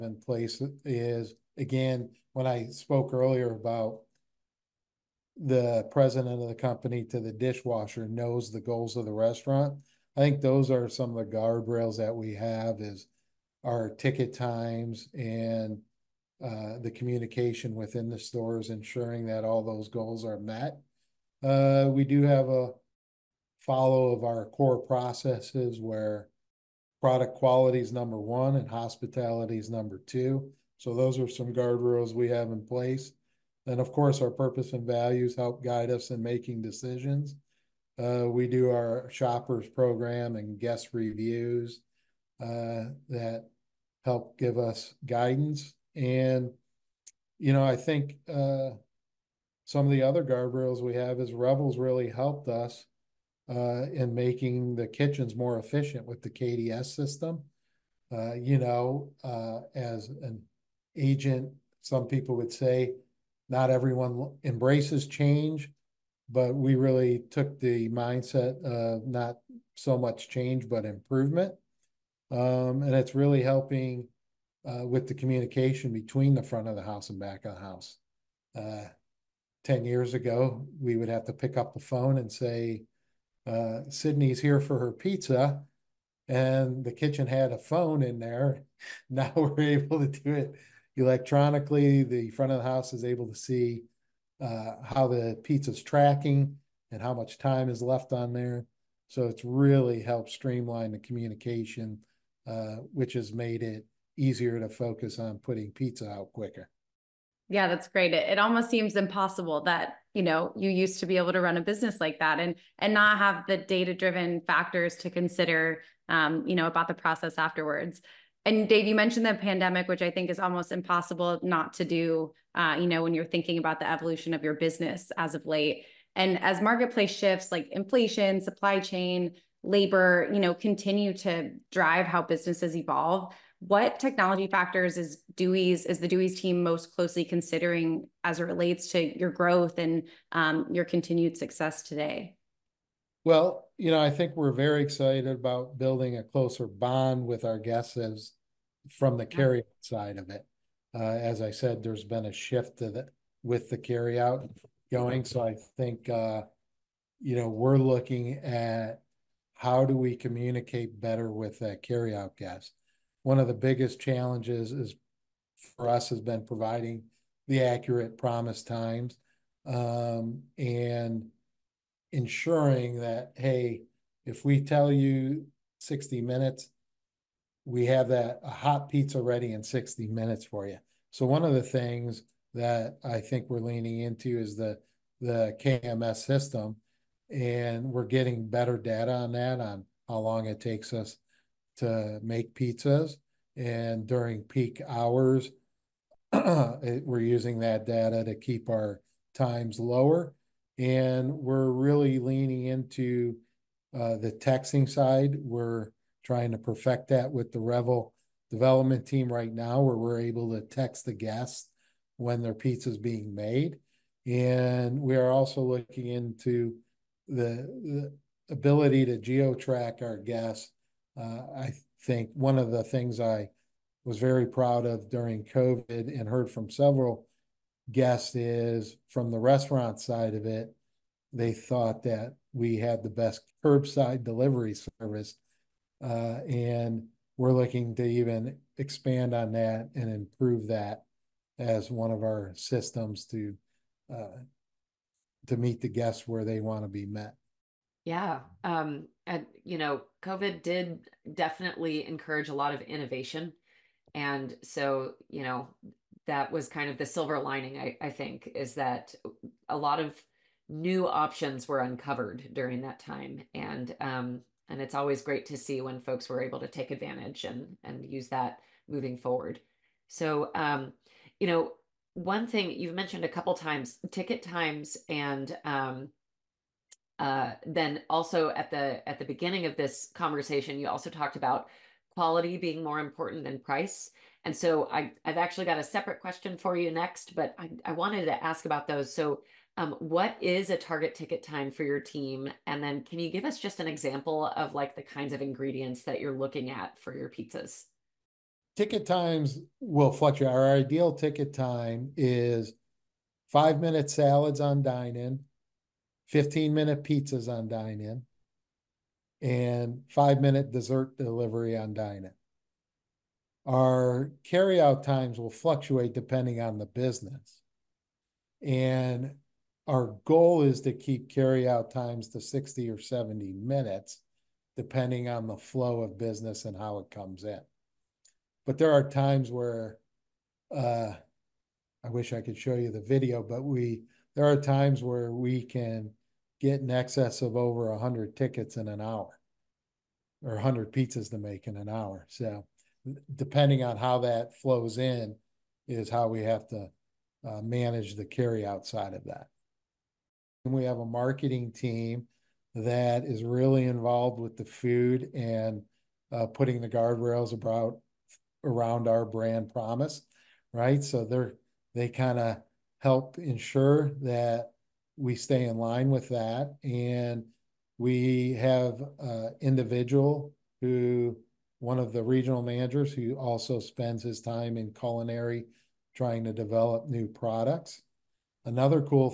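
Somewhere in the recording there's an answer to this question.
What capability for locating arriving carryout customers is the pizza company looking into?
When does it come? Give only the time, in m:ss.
3:39.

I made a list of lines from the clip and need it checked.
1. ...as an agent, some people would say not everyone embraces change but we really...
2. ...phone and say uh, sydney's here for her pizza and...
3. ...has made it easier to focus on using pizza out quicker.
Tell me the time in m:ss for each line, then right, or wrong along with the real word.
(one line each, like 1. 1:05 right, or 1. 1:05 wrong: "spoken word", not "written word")
1. 0:59 right
2. 1:21 right
3. 1:43 wrong: "putting", not "using".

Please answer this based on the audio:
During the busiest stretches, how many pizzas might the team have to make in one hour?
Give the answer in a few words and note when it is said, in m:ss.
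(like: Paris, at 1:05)
Over 100, at 5:37.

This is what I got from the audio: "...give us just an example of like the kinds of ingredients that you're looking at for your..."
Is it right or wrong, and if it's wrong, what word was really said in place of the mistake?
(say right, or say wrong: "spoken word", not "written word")
right.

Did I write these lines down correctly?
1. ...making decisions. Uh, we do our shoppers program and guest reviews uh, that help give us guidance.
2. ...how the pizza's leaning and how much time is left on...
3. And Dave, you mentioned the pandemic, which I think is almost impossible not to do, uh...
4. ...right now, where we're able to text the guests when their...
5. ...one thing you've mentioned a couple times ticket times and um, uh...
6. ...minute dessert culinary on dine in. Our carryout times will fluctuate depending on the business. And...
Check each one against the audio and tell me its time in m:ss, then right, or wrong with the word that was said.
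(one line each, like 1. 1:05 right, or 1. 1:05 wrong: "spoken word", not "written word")
1. 0:36 right
2. 1:34 wrong: "tracking", not "leaning"
3. 1:58 right
4. 3:29 right
5. 4:32 right
6. 5:10 wrong: "delivery", not "culinary".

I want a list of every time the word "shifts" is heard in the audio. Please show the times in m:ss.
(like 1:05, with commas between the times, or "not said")
2:07, 2:32.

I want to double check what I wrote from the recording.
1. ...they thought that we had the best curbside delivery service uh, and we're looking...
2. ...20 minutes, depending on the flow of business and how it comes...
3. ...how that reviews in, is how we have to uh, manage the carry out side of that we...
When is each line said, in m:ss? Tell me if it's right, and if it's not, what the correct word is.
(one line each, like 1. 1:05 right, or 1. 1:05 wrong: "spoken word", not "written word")
1. 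3:51 right
2. 5:22 wrong: "70", not "20"
3. 5:43 wrong: "flows", not "reviews".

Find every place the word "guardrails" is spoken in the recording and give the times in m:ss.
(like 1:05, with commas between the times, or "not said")
0:11, 0:31, 0:50, 5:56.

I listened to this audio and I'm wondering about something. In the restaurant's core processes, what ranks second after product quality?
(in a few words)
Hospitality.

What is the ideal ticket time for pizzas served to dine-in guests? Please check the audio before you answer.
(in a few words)
15 minutes.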